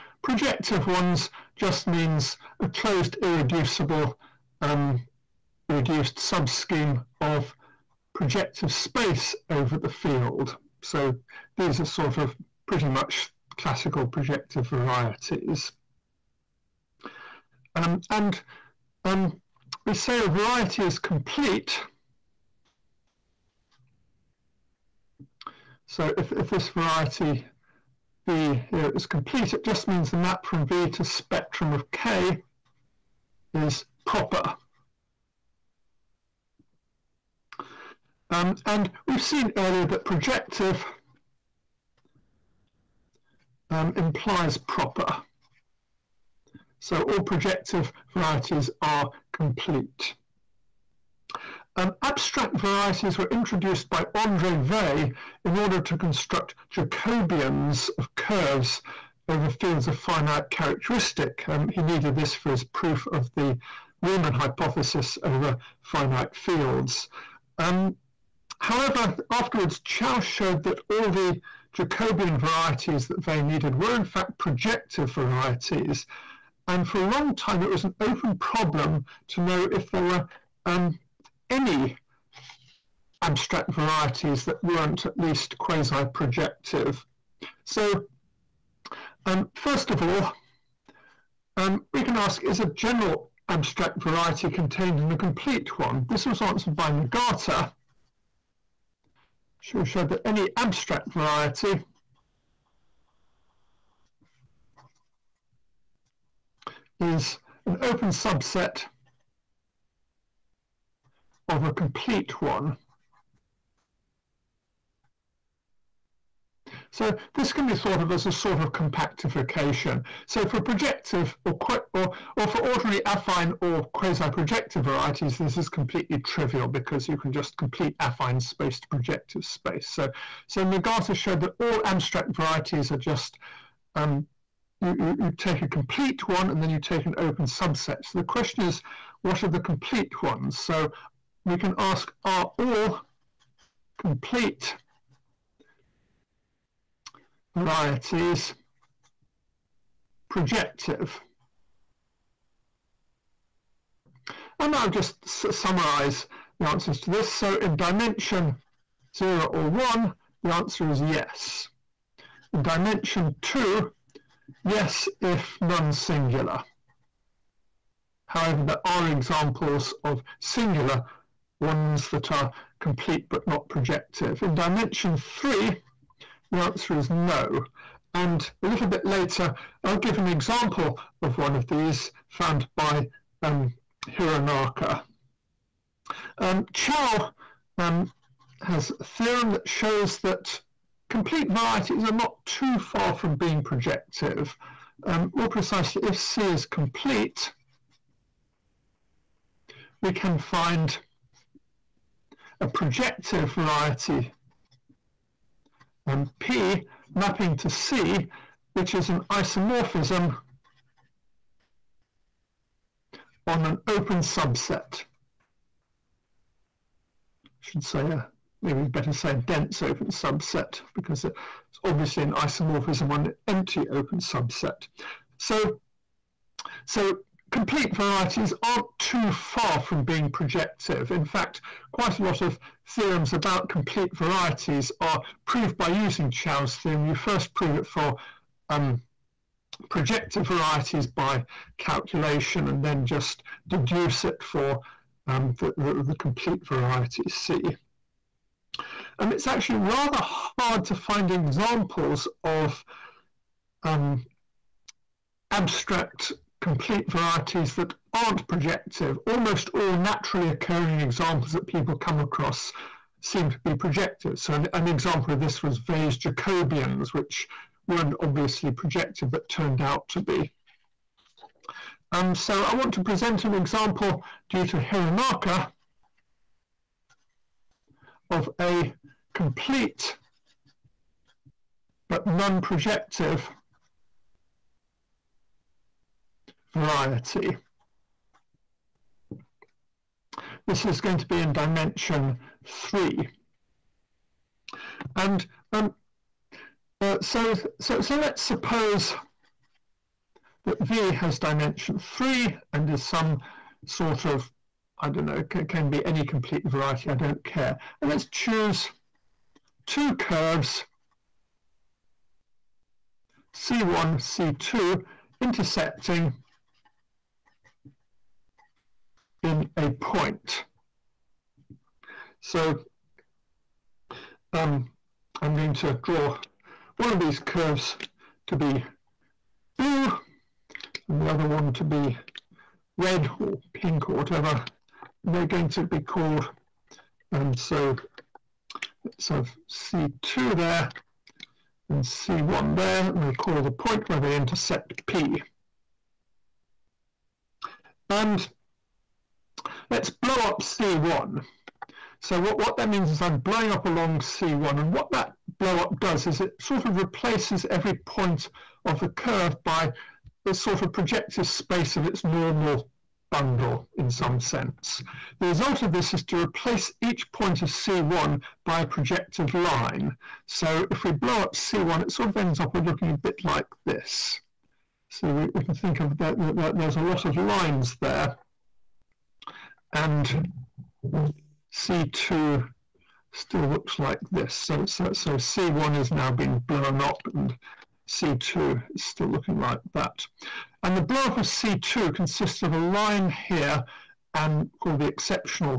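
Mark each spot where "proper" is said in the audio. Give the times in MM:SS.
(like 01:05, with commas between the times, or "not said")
00:34, 00:44.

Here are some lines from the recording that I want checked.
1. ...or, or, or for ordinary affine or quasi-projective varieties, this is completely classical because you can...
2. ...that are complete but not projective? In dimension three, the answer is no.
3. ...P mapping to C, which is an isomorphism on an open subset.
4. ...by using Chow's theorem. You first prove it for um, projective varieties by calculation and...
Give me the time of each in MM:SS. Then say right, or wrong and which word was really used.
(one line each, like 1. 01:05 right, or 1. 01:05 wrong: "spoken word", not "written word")
1. 02:01 wrong: "trivial", not "classical"
2. 02:52 right
3. 03:26 right
4. 03:55 right.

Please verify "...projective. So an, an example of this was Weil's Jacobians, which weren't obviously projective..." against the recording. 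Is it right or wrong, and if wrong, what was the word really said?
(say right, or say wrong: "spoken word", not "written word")
right.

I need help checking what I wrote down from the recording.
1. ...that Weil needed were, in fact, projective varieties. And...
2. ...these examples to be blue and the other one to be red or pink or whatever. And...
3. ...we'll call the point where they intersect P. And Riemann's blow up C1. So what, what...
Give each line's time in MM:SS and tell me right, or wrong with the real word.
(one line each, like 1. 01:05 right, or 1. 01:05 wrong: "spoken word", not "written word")
1. 01:13 right
2. 05:27 wrong: "curves", not "examples"
3. 05:43 wrong: "Let", not "Riemann".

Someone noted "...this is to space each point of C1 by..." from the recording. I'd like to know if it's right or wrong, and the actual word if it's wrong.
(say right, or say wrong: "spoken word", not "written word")
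wrong: "replace", not "space".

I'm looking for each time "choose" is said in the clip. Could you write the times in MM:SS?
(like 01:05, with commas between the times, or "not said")
05:08.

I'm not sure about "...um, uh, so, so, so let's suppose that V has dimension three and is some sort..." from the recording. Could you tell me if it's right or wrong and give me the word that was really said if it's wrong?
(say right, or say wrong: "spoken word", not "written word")
right.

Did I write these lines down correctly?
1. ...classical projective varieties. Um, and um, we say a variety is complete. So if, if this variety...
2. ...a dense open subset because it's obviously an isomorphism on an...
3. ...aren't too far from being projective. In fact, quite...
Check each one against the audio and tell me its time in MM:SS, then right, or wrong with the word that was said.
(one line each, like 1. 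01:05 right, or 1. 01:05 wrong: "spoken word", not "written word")
1. 00:13 right
2. 03:39 right
3. 03:48 right.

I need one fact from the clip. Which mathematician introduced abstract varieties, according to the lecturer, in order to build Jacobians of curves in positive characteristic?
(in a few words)
Andre Weil.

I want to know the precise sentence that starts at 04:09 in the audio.
Um, it's actually rather hard to find examples of um, abstract complete varieties that aren't projective.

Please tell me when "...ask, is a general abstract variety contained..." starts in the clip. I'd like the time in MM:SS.
01:32.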